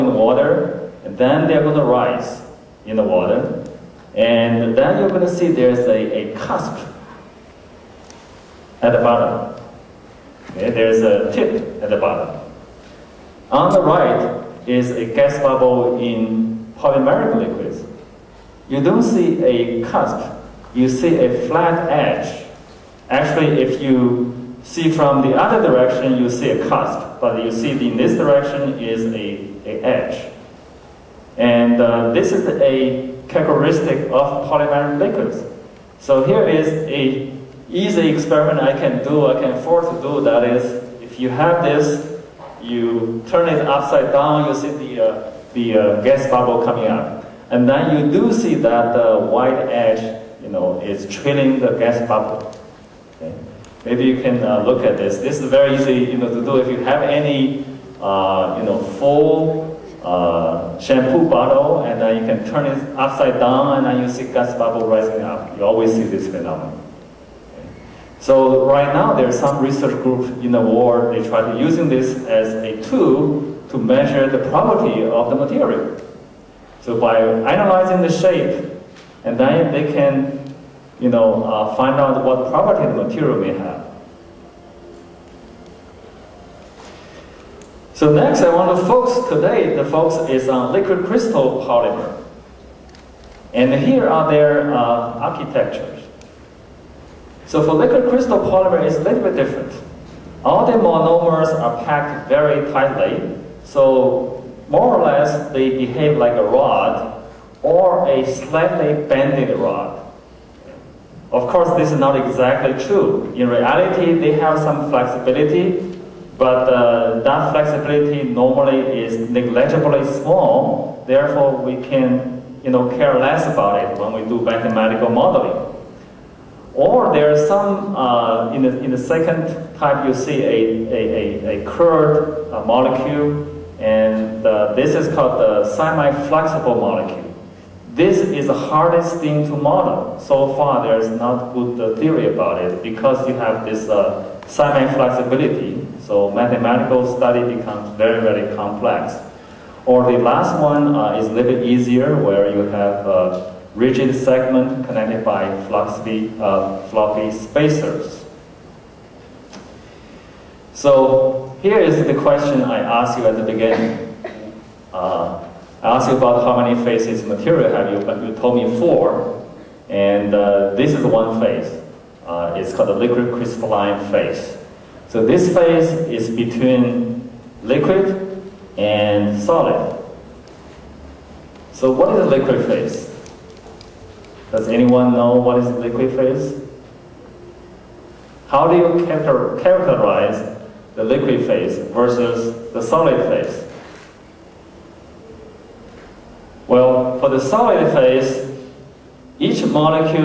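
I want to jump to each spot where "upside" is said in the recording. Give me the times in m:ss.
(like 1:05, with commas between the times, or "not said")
0:43, 1:02.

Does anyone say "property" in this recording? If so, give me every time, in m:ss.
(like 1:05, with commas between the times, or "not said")
1:14, 1:22.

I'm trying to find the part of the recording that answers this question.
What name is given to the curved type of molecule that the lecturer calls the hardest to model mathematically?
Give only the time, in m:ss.
2:15.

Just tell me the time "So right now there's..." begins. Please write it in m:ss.
1:08.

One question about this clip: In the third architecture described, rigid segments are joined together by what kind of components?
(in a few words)
Floppy spacers.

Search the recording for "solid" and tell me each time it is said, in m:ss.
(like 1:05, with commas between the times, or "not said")
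2:59, 3:12, 3:17.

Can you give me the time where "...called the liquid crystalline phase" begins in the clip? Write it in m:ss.
2:52.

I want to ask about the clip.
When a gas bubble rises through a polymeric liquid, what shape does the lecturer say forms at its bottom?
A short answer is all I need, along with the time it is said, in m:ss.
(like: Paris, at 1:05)
A flat edge, at 0:21.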